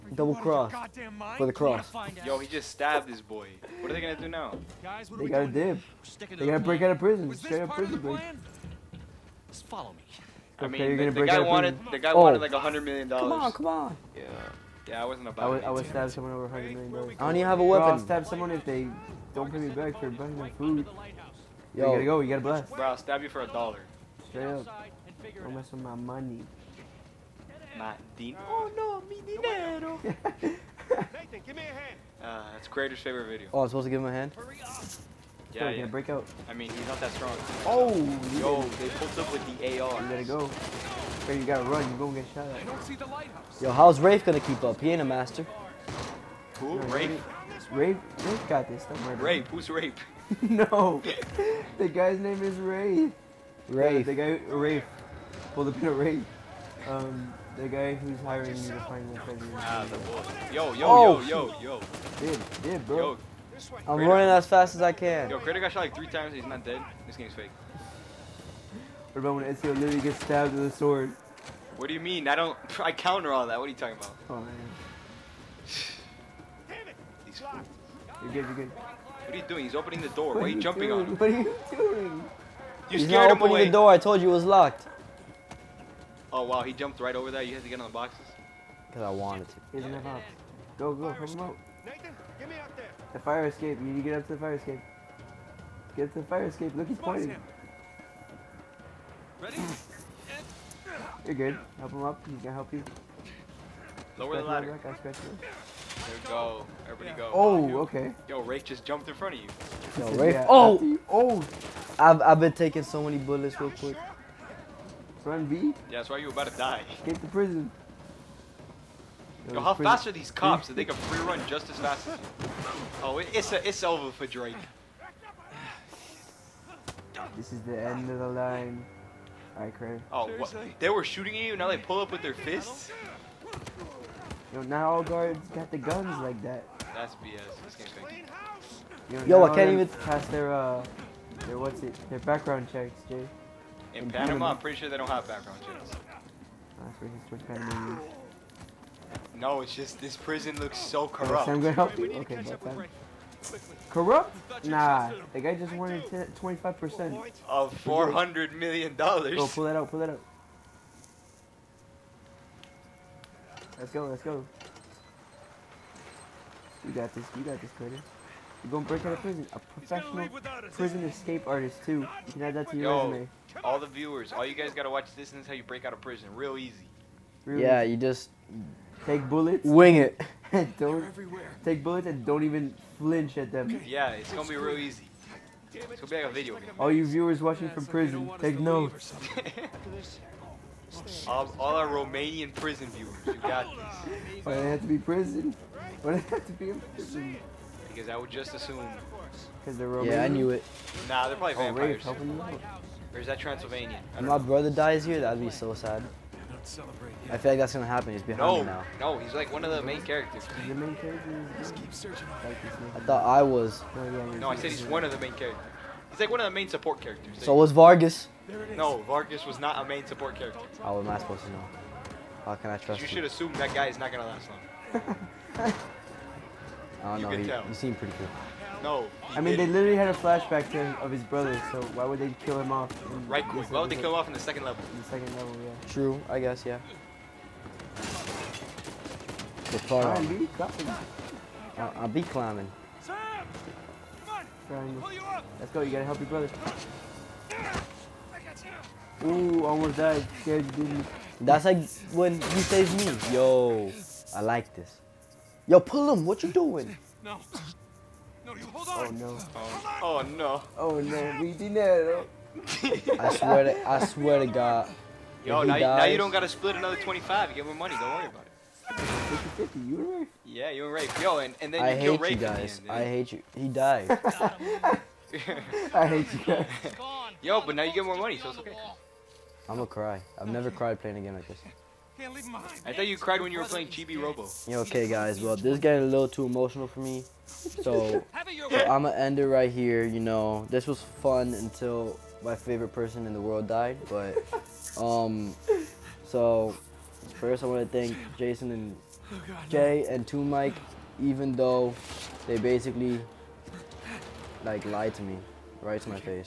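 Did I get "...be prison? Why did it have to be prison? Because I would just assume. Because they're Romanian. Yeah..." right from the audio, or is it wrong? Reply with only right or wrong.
right.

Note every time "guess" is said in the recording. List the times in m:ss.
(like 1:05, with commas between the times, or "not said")
3:56.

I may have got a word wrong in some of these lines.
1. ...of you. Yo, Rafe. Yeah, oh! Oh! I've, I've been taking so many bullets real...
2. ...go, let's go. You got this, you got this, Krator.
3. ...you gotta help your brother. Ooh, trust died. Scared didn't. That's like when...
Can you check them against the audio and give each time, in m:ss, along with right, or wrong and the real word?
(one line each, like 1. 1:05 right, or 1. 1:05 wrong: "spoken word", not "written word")
1. 1:49 right
2. 2:43 right
3. 4:05 wrong: "almost", not "trust".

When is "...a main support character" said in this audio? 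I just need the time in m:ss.
3:39.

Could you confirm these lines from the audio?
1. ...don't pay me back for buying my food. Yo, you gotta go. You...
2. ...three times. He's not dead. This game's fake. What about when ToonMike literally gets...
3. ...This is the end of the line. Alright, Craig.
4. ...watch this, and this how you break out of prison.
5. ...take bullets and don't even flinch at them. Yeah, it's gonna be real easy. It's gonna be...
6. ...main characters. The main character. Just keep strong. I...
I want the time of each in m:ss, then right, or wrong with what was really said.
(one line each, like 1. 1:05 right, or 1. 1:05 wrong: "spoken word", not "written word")
1. 0:19 right
2. 1:05 wrong: "Ezio", not "ToonMike"
3. 2:07 right
4. 2:54 right
5. 3:01 right
6. 3:29 wrong: "searching", not "strong".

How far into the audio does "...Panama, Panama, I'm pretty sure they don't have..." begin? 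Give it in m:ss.
2:24.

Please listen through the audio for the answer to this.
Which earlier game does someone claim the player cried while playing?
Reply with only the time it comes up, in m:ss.
4:43.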